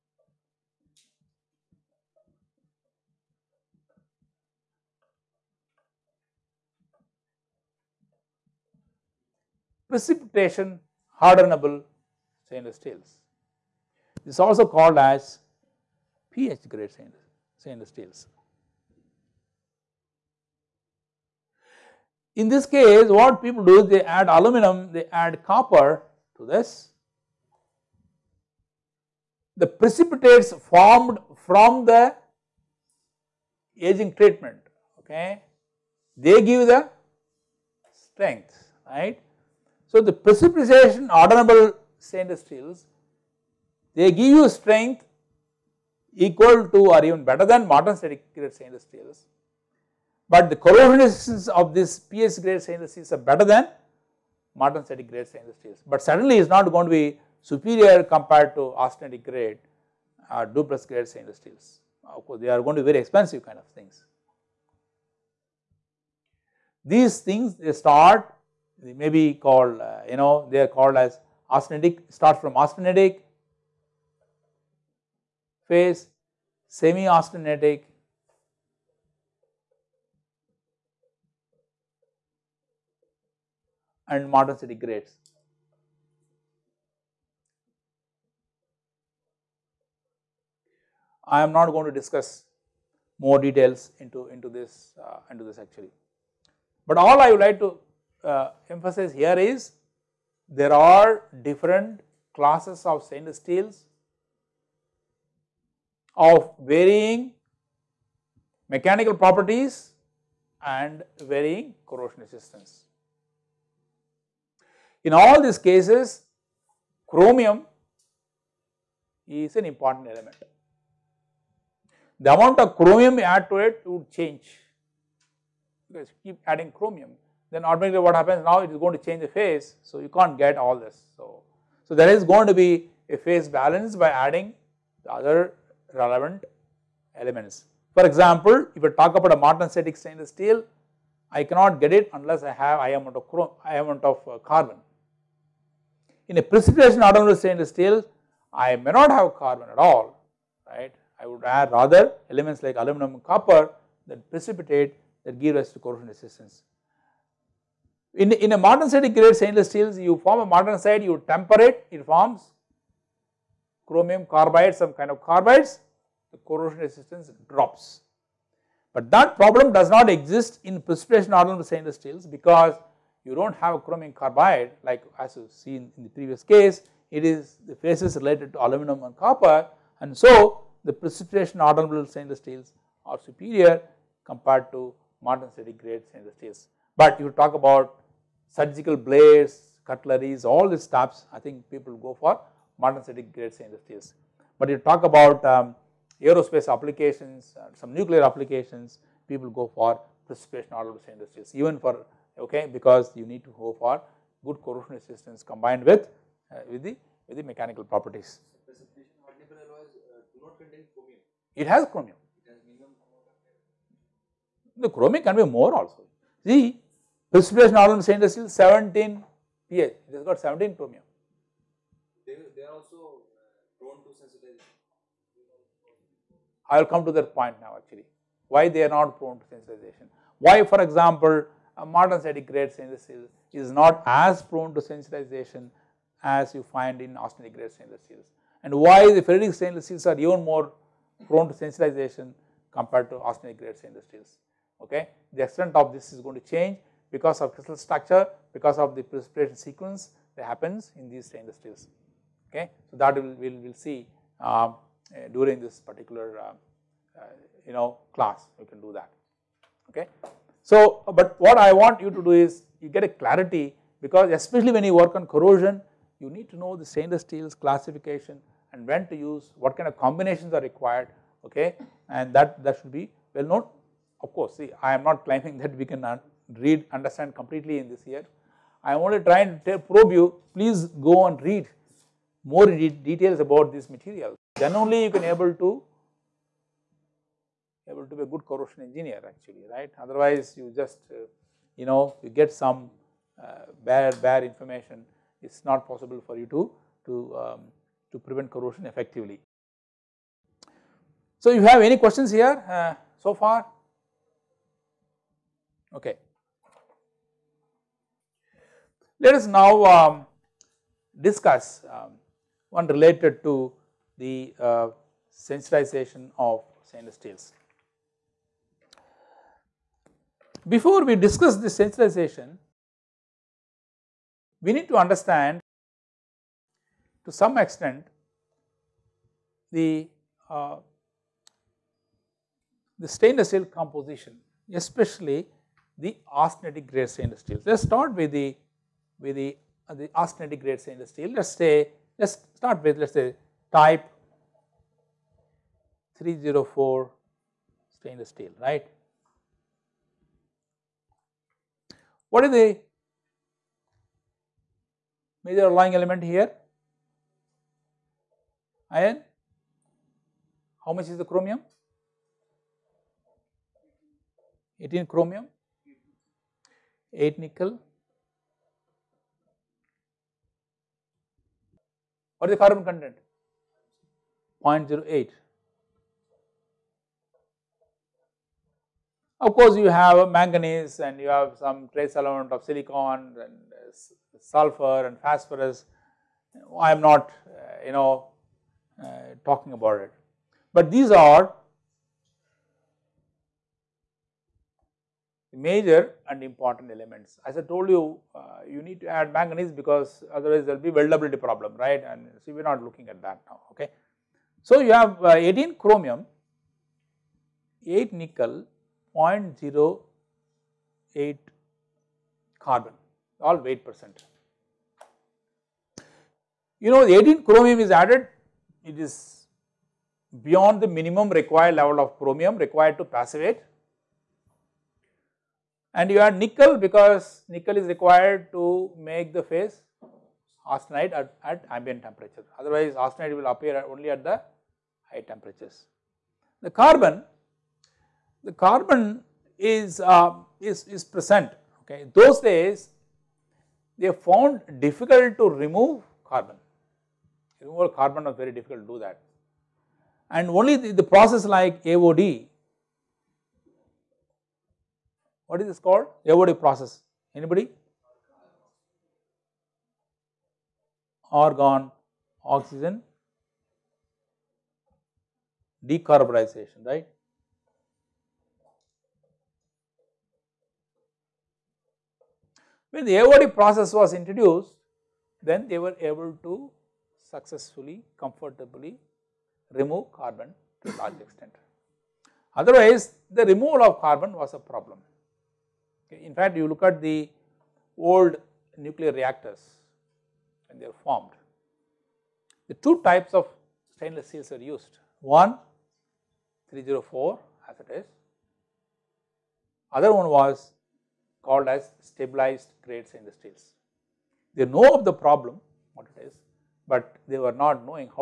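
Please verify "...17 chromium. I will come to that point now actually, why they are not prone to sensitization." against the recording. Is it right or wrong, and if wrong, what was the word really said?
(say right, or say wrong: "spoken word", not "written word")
right.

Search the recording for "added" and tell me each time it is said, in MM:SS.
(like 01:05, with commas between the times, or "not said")
06:57.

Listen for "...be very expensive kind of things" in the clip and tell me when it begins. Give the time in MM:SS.
01:02.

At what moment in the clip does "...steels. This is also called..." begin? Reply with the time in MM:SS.
00:12.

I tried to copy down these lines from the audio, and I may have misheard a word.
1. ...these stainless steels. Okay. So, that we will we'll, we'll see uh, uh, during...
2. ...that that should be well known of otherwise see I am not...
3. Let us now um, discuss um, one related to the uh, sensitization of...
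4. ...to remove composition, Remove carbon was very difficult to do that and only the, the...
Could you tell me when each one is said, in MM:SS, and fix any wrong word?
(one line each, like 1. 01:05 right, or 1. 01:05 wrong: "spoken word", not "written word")
1. 04:11 right
2. 04:32 wrong: "course", not "otherwise"
3. 05:09 right
4. 07:25 wrong: "carbon", not "composition".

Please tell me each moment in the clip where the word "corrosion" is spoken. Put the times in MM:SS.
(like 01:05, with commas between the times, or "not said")
00:50, 01:51, 02:35, 02:46, 03:24, 04:25, 04:48, 04:58.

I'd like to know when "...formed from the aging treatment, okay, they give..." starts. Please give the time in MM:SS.
00:30.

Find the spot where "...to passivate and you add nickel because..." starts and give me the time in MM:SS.
07:02.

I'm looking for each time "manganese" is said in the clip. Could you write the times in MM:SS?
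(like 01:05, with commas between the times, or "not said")
06:20, 06:39.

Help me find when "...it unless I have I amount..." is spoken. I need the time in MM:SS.
02:21.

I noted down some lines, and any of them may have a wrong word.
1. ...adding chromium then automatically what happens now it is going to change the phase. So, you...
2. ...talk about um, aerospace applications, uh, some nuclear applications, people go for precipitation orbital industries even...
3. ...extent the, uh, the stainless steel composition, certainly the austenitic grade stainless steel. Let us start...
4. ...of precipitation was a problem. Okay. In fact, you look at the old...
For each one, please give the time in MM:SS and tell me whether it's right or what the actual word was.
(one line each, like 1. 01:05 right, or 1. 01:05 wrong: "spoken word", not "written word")
1. 02:06 right
2. 03:14 right
3. 05:27 wrong: "especially", not "certainly"
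4. 08:03 wrong: "carbon", not "precipitation".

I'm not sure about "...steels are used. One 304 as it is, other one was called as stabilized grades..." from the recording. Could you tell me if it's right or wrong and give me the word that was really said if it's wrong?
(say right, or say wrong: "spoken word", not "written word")
right.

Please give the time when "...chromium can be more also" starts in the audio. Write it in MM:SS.
03:34.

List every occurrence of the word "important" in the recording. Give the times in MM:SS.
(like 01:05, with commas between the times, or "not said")
01:59, 06:36.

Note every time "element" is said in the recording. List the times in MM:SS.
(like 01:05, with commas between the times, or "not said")
02:00, 02:17, 02:32, 05:55, 06:22, 06:36.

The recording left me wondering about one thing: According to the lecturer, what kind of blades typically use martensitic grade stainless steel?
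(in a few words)
surgical blades.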